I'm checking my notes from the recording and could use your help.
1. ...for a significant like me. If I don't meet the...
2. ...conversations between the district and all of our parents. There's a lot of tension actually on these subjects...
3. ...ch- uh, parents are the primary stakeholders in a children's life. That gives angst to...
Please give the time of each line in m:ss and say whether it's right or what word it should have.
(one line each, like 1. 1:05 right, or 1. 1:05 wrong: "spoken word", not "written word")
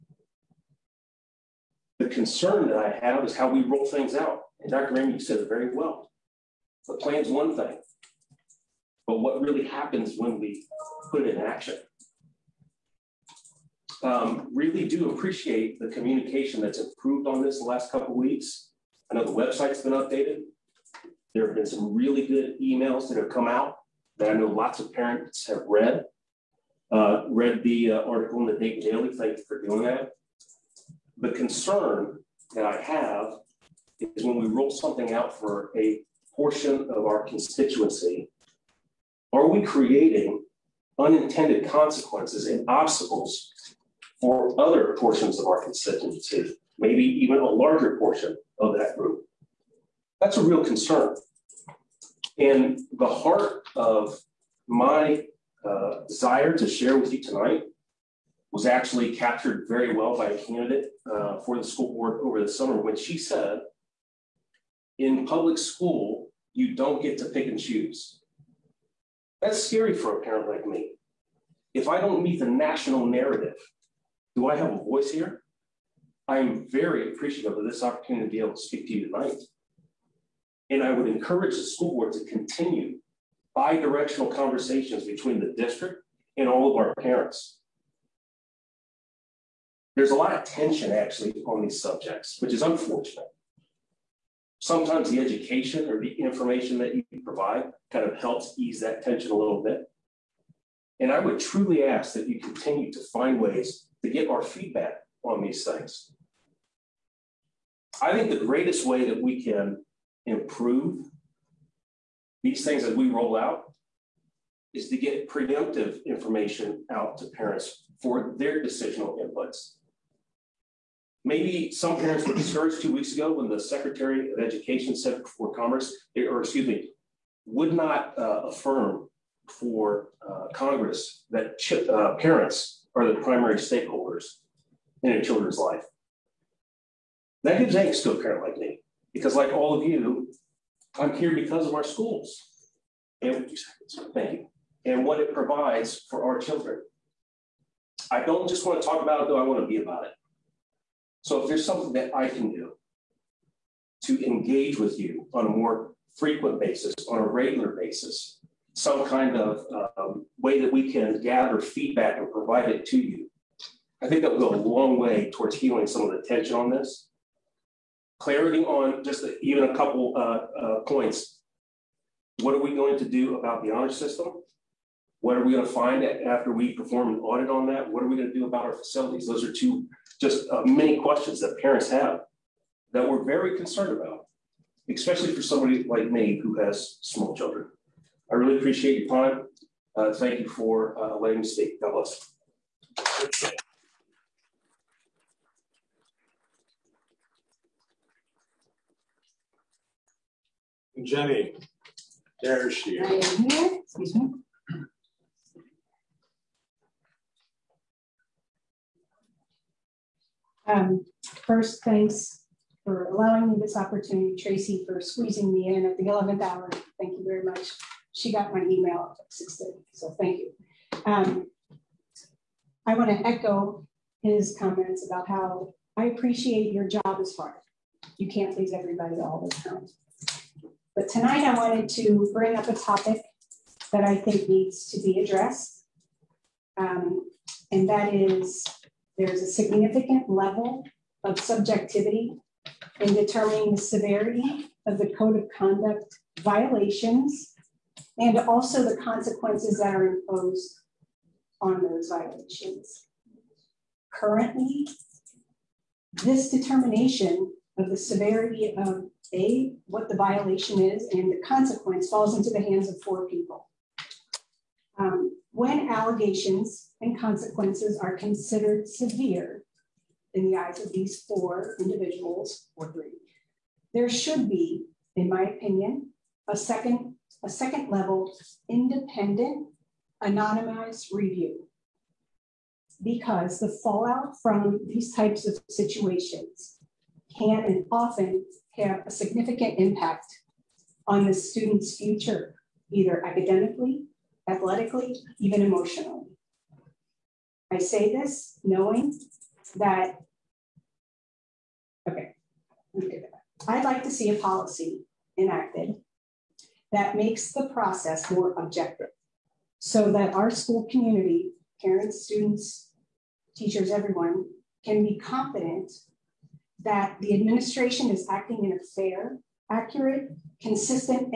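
1. 1:09 wrong: "parent", not "significant"
2. 1:24 right
3. 2:11 right.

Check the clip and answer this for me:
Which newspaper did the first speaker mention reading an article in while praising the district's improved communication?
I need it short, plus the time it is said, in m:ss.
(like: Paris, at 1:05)
Dayton Daily, at 0:28.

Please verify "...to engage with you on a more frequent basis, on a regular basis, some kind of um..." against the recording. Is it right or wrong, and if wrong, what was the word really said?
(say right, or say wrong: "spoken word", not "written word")
right.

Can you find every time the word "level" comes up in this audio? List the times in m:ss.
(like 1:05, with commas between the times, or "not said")
4:00, 4:37.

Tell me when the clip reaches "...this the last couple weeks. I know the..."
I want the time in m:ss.
0:17.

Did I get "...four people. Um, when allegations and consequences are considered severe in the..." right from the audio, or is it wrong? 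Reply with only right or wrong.
right.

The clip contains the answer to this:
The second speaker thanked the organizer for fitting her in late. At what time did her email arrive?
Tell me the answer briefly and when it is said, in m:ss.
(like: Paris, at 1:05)
6:30, at 3:39.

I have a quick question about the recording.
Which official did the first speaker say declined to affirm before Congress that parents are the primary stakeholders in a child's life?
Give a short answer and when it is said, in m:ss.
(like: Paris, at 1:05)
Secretary of Education, at 2:03.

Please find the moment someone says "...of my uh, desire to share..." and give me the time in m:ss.
0:53.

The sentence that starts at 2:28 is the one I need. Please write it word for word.
I don't just want to talk about it, though I want to be about it.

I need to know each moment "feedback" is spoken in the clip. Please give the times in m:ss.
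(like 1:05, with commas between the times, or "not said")
1:44, 2:41.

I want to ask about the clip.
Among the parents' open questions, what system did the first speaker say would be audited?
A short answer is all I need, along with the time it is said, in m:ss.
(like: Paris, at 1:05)
honor system, at 2:53.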